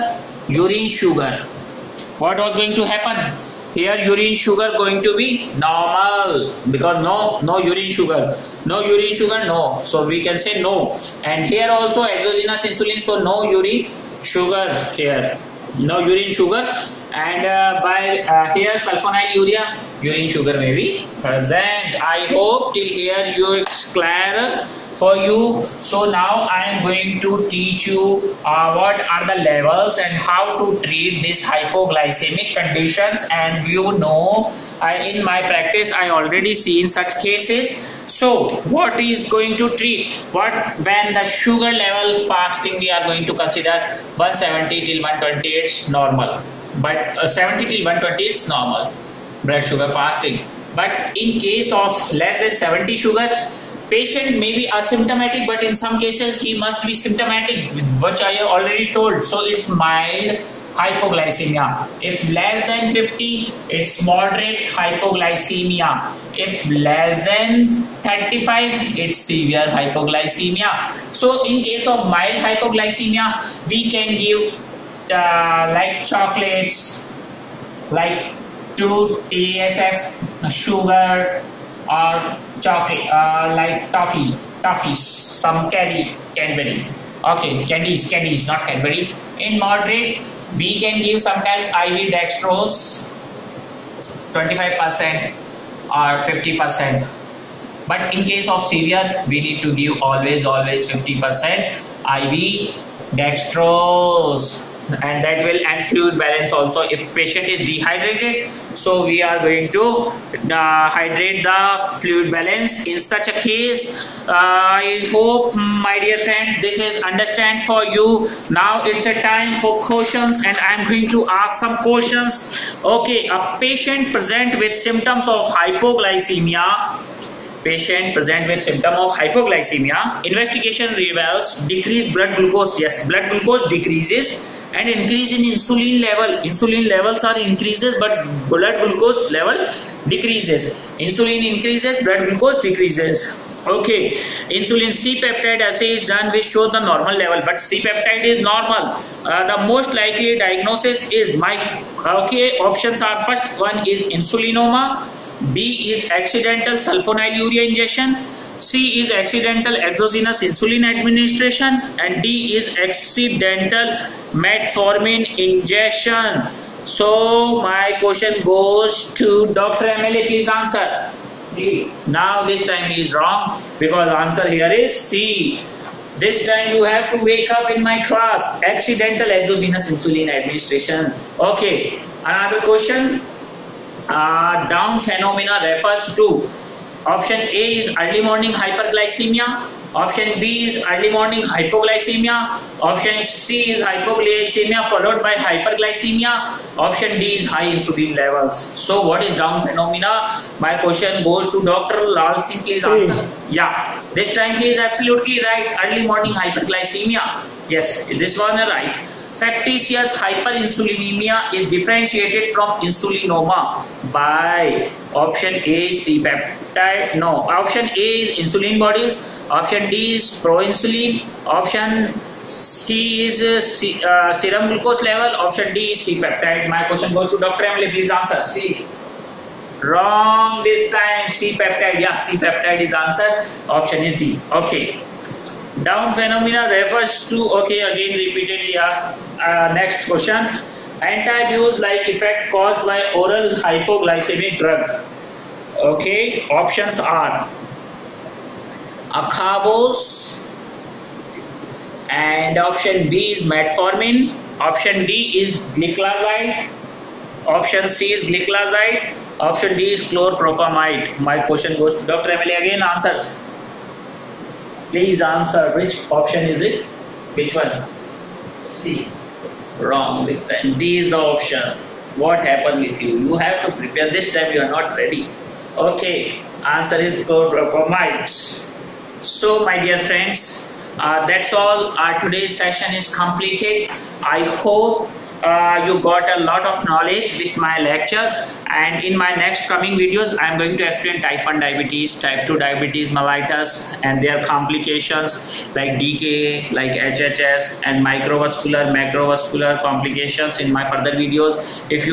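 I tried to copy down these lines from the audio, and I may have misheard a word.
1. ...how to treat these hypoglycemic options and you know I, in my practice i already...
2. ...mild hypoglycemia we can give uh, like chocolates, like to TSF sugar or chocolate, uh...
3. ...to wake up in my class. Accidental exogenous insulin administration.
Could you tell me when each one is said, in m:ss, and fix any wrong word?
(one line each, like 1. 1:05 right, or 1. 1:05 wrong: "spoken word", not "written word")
1. 0:30 wrong: "conditions", not "options"
2. 1:12 right
3. 2:57 right.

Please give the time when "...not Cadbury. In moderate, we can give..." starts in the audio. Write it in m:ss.
1:28.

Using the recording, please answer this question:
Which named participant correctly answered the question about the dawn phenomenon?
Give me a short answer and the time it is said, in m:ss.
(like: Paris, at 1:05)
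Dr. Lal Singh, at 3:21.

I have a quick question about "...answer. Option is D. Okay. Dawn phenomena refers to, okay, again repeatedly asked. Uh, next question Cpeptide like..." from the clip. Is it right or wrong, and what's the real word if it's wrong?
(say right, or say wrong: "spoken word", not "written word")
wrong: "Antabuse", not "Cpeptide".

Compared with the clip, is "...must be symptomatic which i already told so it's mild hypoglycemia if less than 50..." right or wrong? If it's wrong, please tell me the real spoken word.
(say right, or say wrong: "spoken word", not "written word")
right.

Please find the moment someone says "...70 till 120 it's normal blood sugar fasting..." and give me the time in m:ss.
0:47.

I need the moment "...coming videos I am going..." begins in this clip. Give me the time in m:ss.
4:49.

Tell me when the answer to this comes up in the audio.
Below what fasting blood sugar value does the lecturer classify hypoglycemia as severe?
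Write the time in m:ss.
1:06.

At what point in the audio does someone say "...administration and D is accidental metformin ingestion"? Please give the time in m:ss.
2:40.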